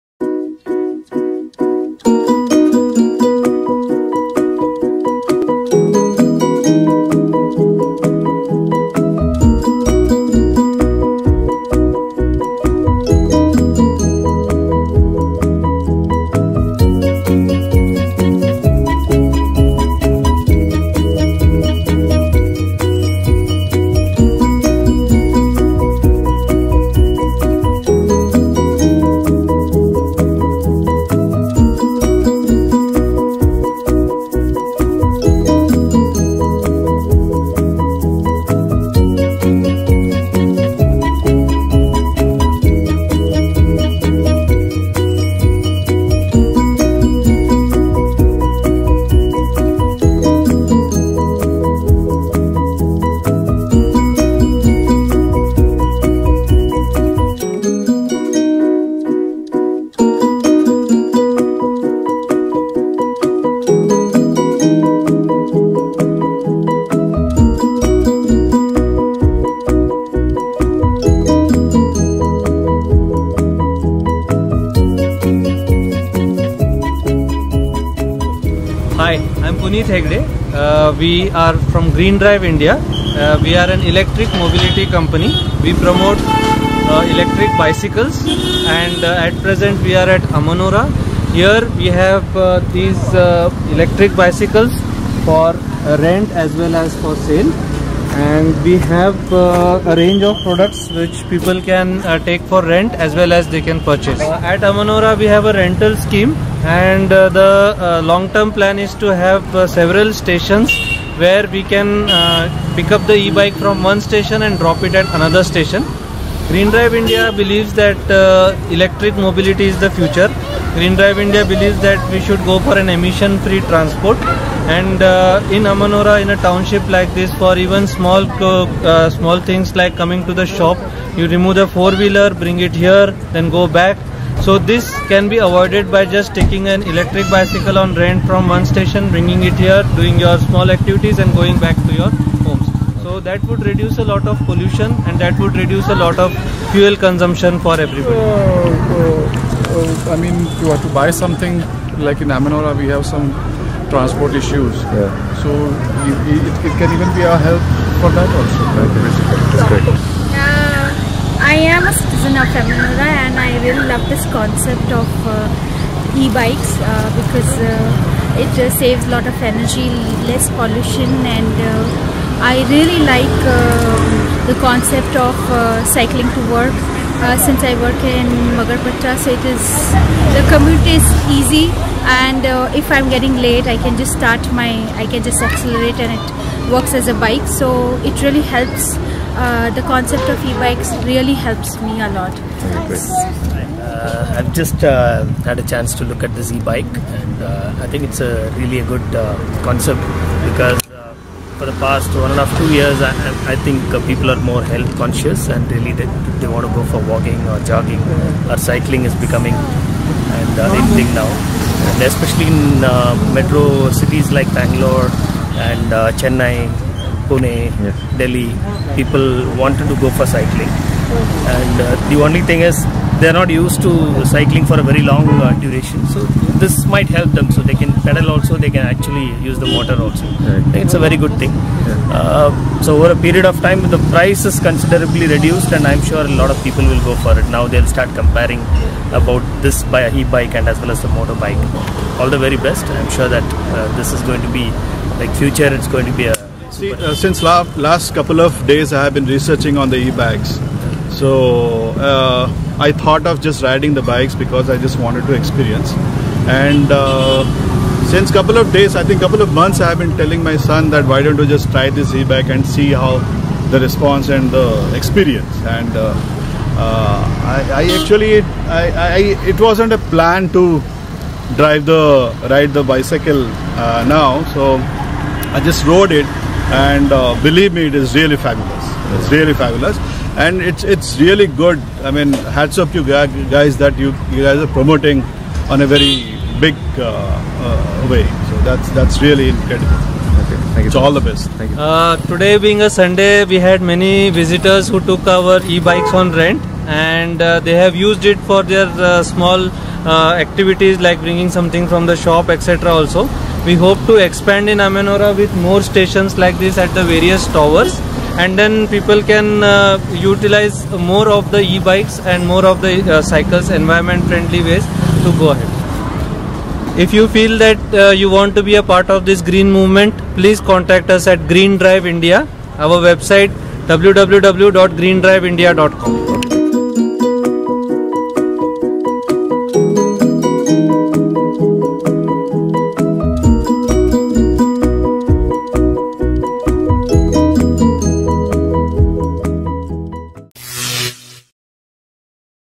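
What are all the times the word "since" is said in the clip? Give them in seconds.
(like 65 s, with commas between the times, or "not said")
177 s, 247 s, 258 s.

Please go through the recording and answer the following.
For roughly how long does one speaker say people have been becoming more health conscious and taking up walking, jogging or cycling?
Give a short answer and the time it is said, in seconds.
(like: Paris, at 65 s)
one and a half two years, at 202 s.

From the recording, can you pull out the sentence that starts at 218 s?
Delhi, people wanted to go for cycling.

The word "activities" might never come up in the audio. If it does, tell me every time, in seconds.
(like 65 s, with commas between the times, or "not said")
140 s, 300 s.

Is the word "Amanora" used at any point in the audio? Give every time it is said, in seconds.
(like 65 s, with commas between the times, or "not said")
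90 s, 104 s, 125 s, 152 s, 162 s, 304 s.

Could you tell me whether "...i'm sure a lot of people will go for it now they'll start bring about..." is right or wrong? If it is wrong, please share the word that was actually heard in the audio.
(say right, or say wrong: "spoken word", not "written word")
wrong: "comparing", not "bring".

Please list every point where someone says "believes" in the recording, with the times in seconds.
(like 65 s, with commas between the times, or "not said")
117 s, 121 s, 277 s.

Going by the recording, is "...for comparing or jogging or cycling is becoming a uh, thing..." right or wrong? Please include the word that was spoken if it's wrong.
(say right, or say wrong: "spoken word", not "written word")
wrong: "walking", not "comparing".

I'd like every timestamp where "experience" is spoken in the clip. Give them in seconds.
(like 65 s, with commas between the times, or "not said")
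255 s, 264 s.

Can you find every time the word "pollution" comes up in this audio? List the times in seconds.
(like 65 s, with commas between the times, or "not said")
144 s, 170 s.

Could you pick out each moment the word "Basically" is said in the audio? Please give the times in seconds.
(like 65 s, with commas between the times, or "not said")
159 s.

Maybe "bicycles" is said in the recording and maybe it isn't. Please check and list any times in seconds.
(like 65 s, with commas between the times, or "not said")
87 s, 94 s, 137 s, 272 s.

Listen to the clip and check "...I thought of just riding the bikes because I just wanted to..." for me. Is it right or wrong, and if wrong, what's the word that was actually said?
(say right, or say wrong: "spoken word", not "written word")
right.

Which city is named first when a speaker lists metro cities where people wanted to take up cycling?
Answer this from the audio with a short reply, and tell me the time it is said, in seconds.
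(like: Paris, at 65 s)
Bangalore, at 214 s.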